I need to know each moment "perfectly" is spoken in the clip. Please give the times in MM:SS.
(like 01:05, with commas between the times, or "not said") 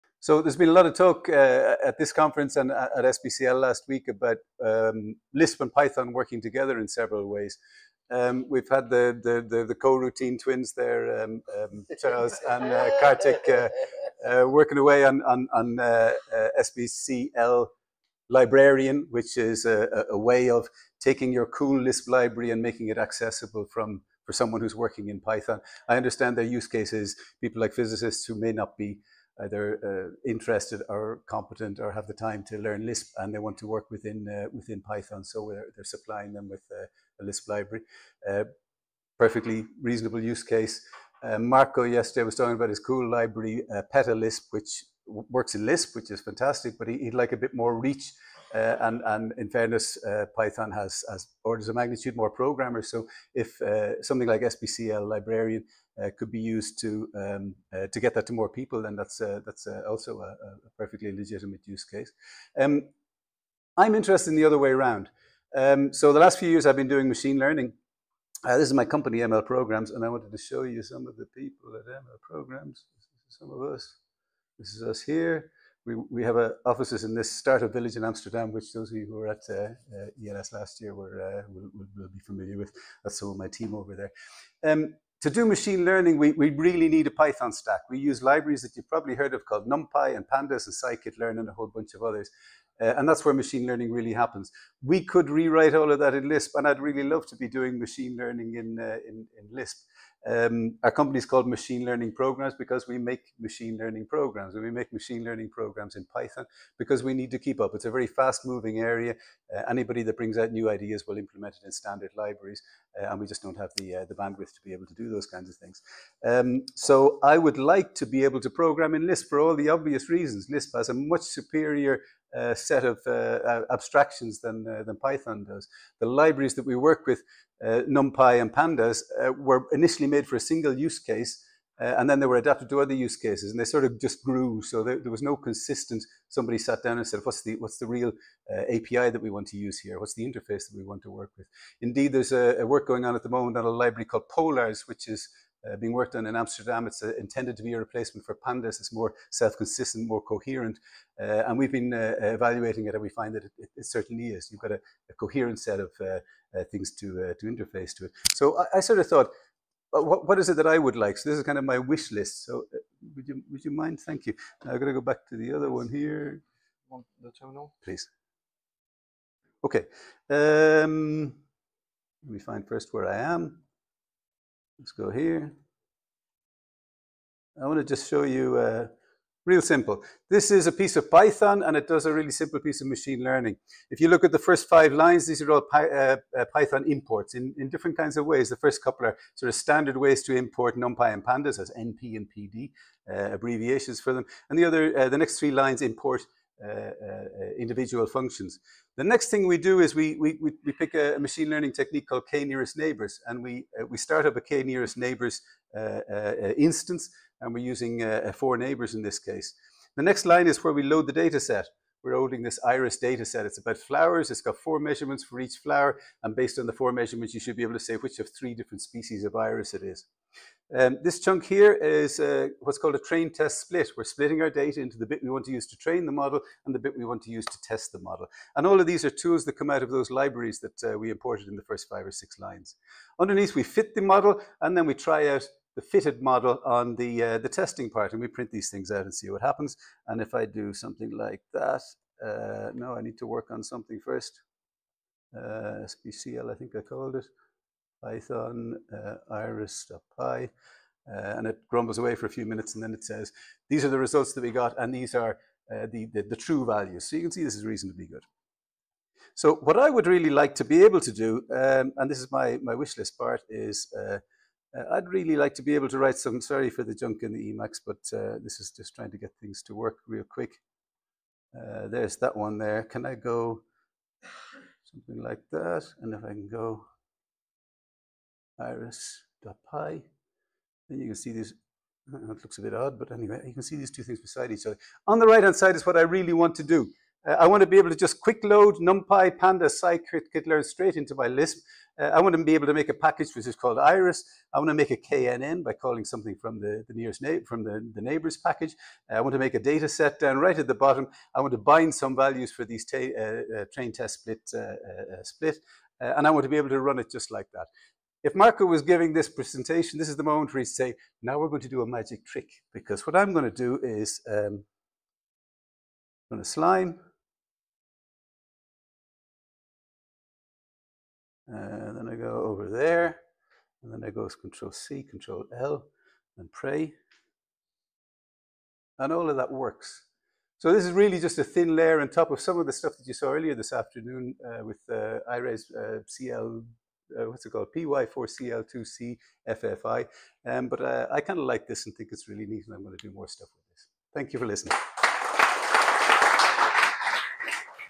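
00:39, 01:00.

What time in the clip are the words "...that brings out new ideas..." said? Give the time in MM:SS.
01:50.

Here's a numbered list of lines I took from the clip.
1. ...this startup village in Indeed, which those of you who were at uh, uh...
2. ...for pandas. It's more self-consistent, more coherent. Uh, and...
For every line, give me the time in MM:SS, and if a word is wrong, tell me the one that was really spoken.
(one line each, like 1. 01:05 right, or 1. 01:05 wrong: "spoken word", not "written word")
1. 01:17 wrong: "Amsterdam", not "Indeed"
2. 02:28 right.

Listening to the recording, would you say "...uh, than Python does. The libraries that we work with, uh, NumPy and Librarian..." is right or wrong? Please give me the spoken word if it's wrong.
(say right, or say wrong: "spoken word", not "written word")
wrong: "Pandas", not "Librarian".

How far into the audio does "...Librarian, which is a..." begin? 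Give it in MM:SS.
00:18.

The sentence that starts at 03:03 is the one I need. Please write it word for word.
If you look at the first five lines, these are all Py uh, uh, Python imports in, in different kinds of ways.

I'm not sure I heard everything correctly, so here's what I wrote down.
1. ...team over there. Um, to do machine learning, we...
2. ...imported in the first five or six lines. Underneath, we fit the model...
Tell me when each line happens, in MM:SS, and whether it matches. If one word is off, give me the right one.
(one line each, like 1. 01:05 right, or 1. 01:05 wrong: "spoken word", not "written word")
1. 01:23 right
2. 03:51 right.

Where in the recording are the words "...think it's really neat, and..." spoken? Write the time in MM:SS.
05:41.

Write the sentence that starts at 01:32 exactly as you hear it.
Uh, and that's where machine learning really happens.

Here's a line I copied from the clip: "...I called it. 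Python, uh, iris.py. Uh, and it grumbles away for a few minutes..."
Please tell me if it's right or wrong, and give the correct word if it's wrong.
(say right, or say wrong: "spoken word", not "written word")
right.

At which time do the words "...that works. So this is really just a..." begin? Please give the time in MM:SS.
05:29.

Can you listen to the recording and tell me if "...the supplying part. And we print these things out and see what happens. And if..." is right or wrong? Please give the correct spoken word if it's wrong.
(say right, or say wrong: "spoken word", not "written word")
wrong: "testing", not "supplying".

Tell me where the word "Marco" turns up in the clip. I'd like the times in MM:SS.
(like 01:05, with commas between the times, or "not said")
00:41, 05:08.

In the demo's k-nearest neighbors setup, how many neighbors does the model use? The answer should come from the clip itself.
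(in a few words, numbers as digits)
4.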